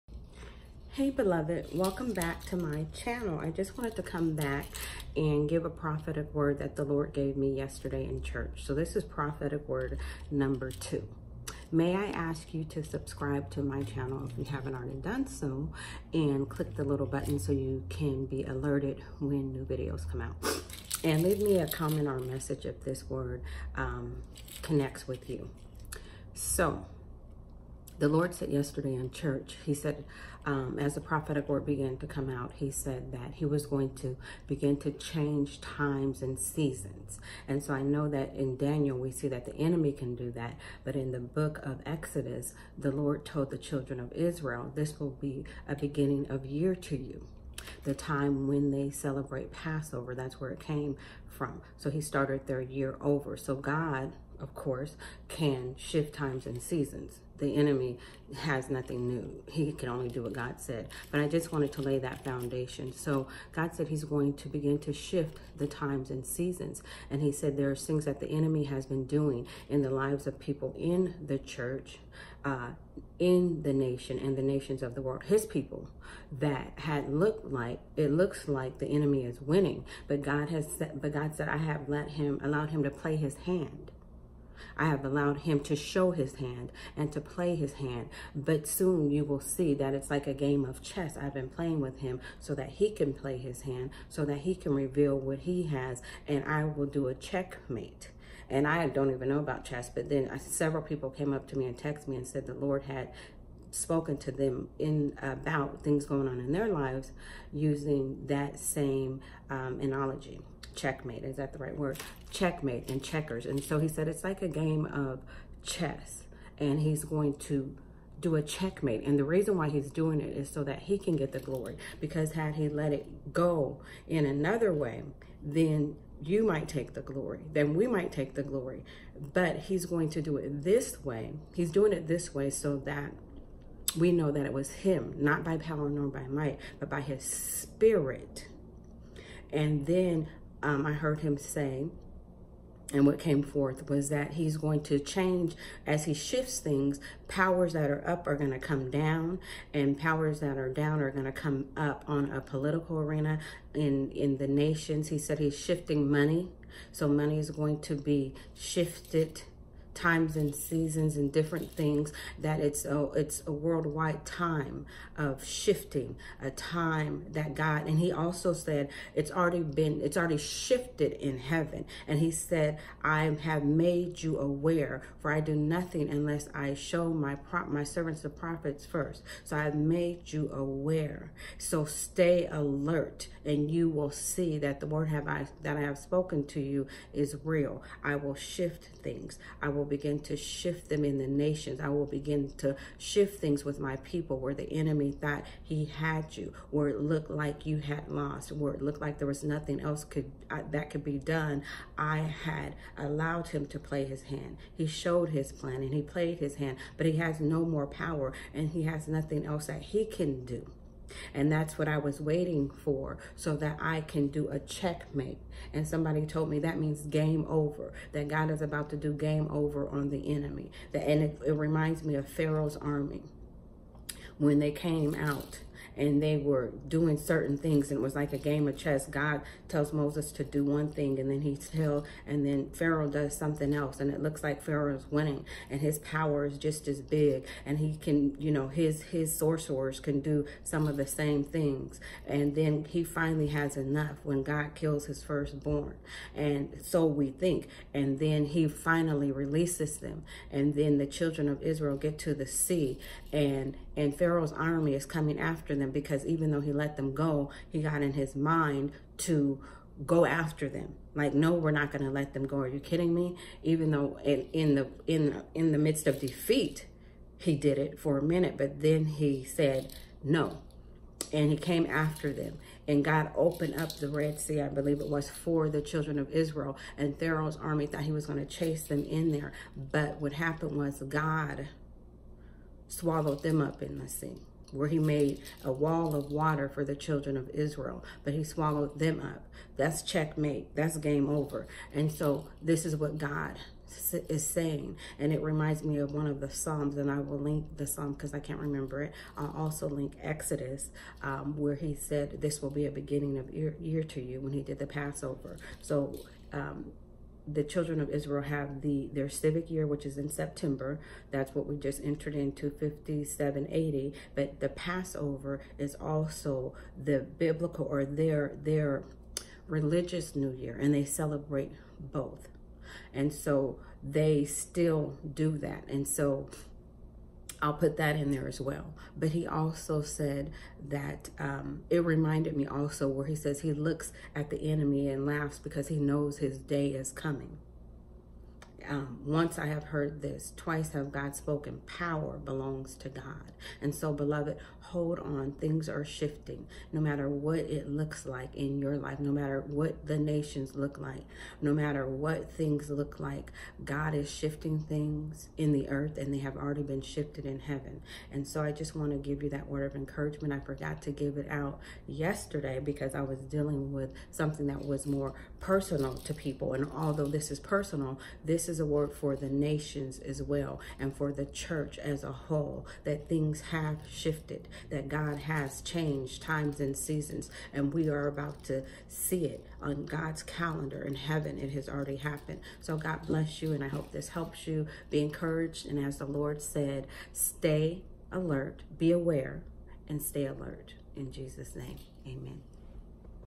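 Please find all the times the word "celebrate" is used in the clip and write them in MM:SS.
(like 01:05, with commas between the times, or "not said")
00:48, 05:21.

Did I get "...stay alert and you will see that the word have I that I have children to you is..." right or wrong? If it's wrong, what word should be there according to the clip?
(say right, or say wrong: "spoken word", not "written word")
wrong: "spoken", not "children".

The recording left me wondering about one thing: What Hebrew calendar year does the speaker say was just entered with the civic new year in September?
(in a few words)
5780.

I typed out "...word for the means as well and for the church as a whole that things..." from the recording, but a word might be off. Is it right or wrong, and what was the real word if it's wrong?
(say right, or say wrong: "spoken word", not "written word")
wrong: "nations", not "means".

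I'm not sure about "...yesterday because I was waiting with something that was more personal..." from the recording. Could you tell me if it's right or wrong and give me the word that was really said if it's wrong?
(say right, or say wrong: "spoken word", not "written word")
wrong: "dealing", not "waiting".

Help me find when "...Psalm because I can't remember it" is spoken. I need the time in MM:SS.
04:57.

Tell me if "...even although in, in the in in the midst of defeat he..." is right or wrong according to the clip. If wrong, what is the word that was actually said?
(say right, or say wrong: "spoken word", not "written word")
wrong: "though", not "although".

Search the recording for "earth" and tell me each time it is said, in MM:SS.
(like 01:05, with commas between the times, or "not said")
05:55.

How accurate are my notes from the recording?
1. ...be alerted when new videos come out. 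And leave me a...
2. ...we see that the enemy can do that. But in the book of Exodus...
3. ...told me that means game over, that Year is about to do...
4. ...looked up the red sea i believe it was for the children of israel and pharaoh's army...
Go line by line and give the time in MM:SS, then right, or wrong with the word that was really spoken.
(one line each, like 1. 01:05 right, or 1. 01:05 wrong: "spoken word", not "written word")
1. 00:18 right
2. 00:38 right
3. 03:36 wrong: "God", not "Year"
4. 04:33 wrong: "opened", not "looked".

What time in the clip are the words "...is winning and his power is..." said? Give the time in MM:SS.
03:54.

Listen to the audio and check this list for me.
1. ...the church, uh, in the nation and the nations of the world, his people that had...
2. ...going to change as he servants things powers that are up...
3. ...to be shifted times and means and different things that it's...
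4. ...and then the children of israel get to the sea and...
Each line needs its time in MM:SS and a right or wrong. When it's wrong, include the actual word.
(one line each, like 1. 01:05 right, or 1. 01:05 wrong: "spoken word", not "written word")
1. 01:11 right
2. 02:24 wrong: "shifts", not "servants"
3. 02:37 wrong: "seasons", not "means"
4. 04:10 right.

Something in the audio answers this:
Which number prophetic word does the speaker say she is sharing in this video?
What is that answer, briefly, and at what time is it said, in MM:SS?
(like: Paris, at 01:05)
2, at 00:09.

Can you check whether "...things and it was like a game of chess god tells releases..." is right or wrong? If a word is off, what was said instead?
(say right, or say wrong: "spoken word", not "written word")
wrong: "moses", not "releases".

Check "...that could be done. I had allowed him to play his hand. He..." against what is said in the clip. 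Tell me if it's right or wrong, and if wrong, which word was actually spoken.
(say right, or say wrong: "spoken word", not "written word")
right.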